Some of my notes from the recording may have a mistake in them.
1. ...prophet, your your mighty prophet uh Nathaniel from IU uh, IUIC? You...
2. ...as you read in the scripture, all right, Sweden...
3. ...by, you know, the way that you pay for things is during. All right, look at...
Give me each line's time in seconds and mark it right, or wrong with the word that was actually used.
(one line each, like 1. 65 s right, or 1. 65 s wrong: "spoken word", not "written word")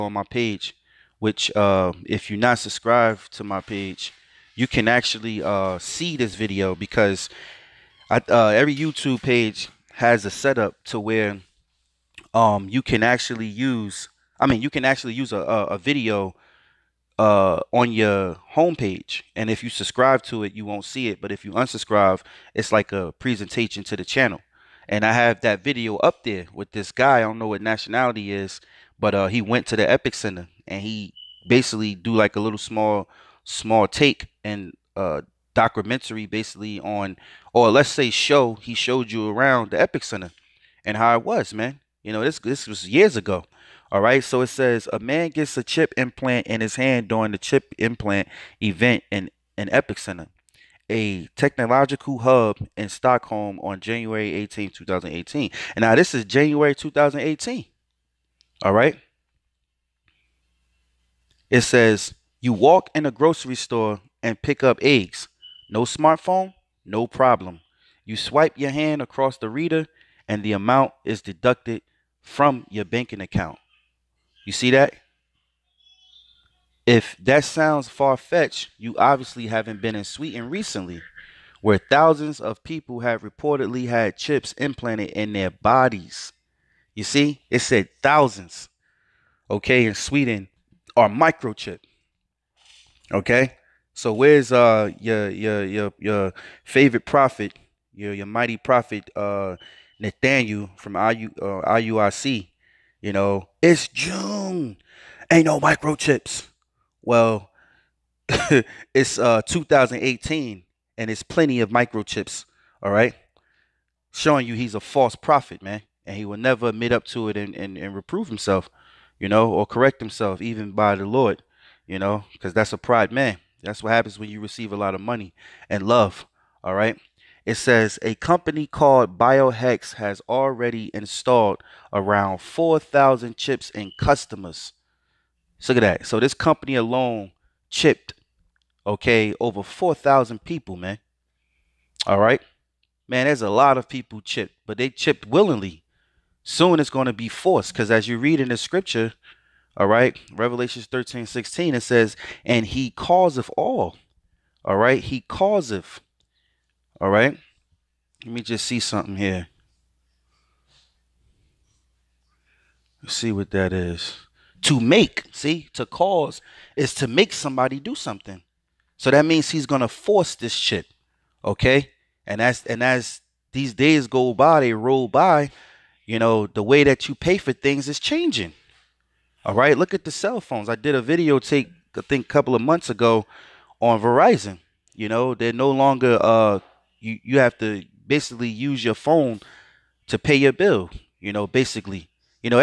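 1. 97 s right
2. 147 s wrong: "Revelations", not "Sweden"
3. 175 s wrong: "changing", not "during".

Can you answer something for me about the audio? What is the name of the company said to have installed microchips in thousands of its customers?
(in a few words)
Biohax.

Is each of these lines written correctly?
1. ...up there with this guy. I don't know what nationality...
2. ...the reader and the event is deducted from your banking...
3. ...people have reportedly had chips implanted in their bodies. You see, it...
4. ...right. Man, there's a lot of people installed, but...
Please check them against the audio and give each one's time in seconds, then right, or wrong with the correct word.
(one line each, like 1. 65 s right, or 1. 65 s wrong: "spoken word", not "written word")
1. 25 s right
2. 69 s wrong: "amount", not "event"
3. 82 s right
4. 142 s wrong: "chipped", not "installed".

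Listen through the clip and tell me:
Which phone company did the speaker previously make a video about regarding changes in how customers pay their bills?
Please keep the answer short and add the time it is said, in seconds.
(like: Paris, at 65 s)
Verizon, at 184 s.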